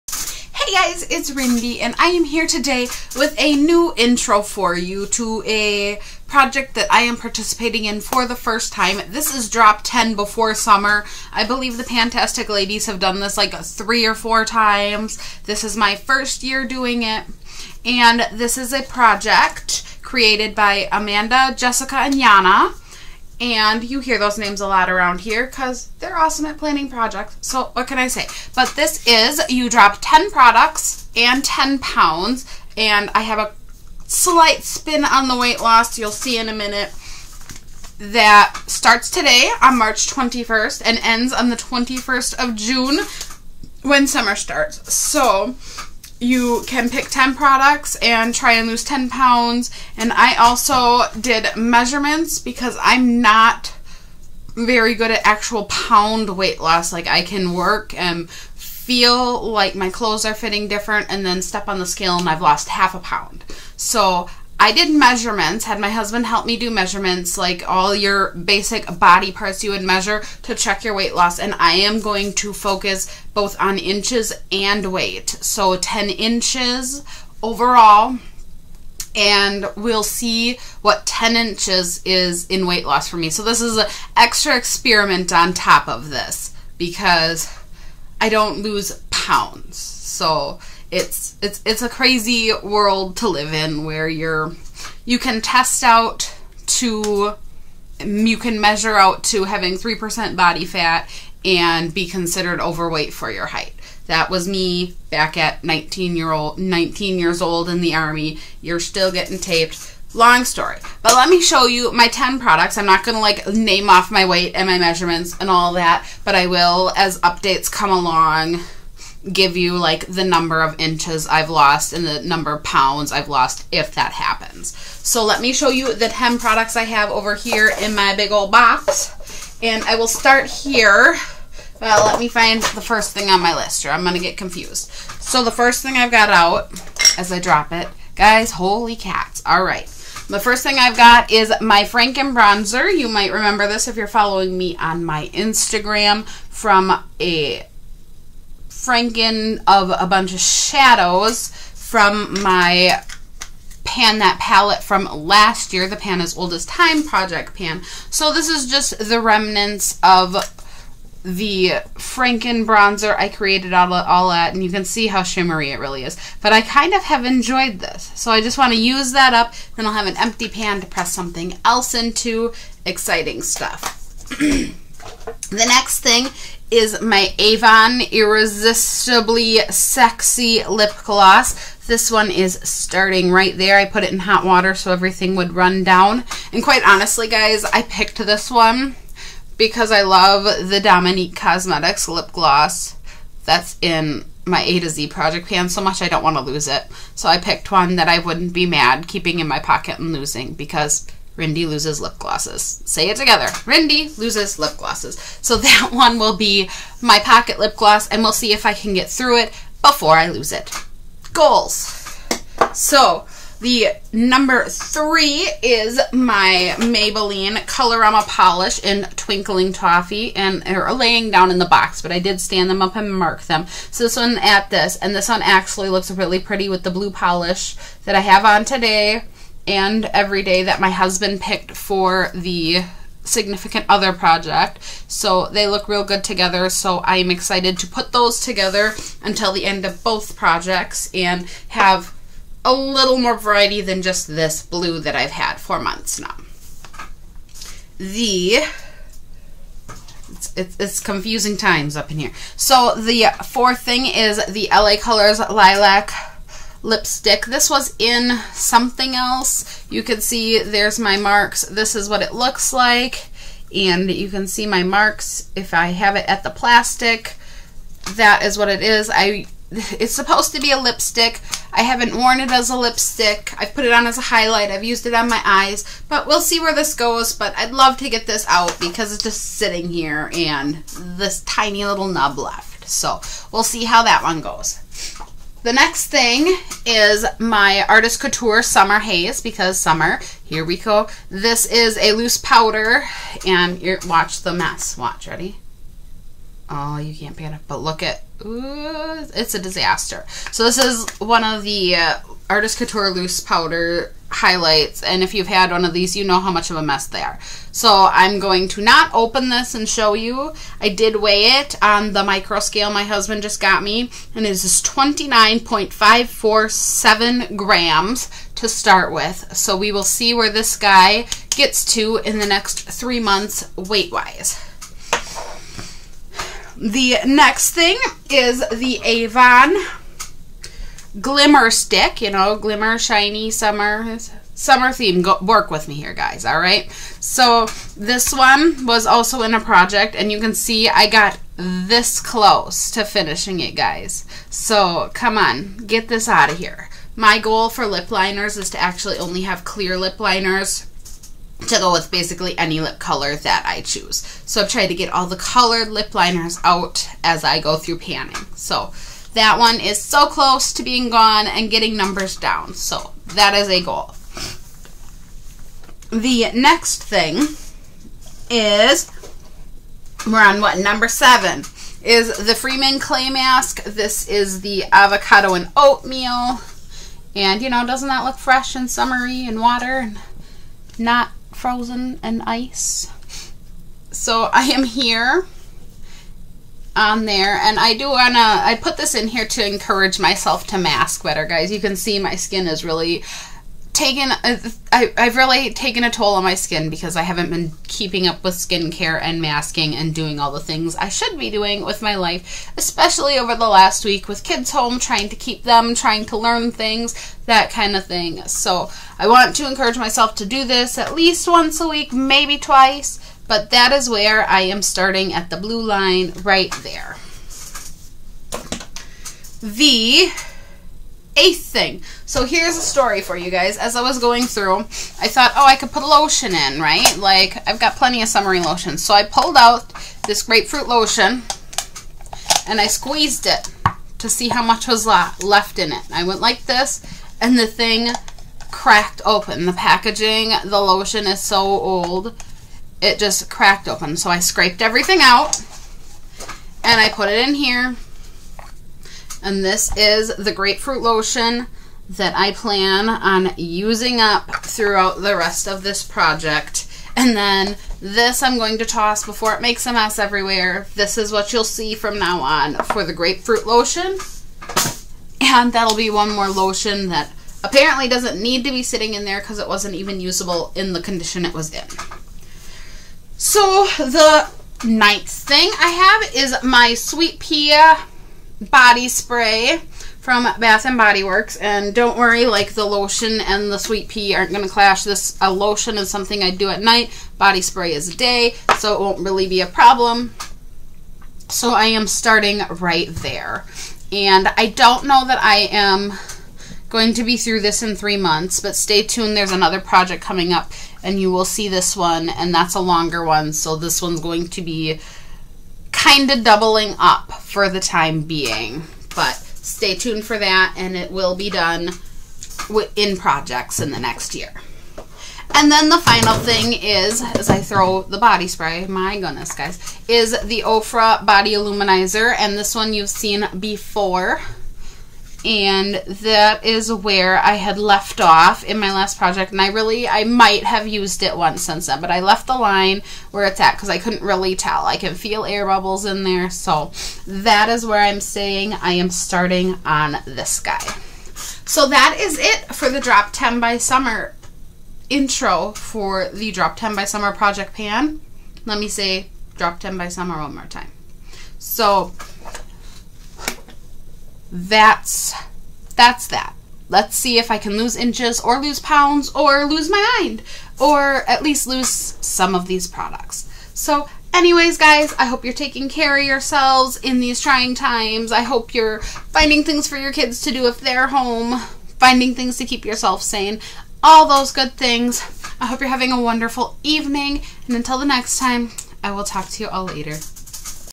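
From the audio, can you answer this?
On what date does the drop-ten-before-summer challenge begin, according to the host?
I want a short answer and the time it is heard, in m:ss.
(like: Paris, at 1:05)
March 21st, at 0:39.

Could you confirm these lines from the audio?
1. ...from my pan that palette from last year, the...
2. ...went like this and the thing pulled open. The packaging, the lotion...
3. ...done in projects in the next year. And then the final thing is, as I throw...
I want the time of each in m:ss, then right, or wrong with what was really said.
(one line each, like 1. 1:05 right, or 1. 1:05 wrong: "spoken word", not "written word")
1. 2:31 right
2. 7:16 wrong: "cracked", not "pulled"
3. 8:31 right.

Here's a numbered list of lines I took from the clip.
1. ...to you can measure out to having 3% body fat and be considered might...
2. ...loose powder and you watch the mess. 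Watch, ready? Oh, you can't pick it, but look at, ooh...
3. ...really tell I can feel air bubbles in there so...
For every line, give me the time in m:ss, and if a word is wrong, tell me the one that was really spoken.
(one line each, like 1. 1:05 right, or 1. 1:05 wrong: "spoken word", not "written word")
1. 1:36 wrong: "overweight", not "might"
2. 4:52 right
3. 8:54 right.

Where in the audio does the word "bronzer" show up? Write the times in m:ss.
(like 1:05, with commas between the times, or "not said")
2:22, 2:42.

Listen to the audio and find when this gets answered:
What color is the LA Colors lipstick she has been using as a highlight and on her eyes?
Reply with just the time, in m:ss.
4:15.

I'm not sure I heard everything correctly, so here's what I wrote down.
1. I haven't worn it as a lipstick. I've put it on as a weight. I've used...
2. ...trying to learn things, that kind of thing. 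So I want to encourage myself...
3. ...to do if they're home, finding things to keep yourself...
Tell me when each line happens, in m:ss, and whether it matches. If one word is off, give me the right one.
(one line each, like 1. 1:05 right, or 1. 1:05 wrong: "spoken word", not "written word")
1. 4:31 wrong: "highlight", not "weight"
2. 6:45 right
3. 9:30 right.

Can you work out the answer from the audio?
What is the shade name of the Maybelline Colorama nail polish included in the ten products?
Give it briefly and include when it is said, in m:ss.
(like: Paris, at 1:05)
Twinkling Toffee, at 3:39.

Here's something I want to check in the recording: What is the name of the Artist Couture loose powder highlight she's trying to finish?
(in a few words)
Summer Haze.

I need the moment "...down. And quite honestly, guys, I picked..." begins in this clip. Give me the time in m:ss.
3:05.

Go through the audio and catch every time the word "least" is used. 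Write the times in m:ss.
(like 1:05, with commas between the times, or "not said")
6:51, 9:21.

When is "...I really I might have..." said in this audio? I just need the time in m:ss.
8:49.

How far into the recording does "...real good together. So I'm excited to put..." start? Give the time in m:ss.
3:55.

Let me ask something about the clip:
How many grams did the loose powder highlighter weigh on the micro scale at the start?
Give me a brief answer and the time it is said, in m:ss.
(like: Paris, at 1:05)
29.547, at 5:14.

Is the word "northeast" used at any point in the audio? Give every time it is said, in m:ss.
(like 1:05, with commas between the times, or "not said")
not said.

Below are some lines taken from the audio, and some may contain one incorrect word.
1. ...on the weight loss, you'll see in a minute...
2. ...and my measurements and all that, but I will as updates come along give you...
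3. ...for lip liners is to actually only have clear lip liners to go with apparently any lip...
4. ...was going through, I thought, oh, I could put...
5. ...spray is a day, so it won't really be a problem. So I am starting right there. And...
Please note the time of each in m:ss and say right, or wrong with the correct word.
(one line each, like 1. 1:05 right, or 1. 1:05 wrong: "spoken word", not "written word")
1. 0:35 right
2. 1:54 right
3. 5:47 wrong: "basically", not "apparently"
4. 7:04 right
5. 8:07 right.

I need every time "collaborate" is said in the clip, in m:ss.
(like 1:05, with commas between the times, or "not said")
not said.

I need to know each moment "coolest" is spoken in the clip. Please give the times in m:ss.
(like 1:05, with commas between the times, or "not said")
not said.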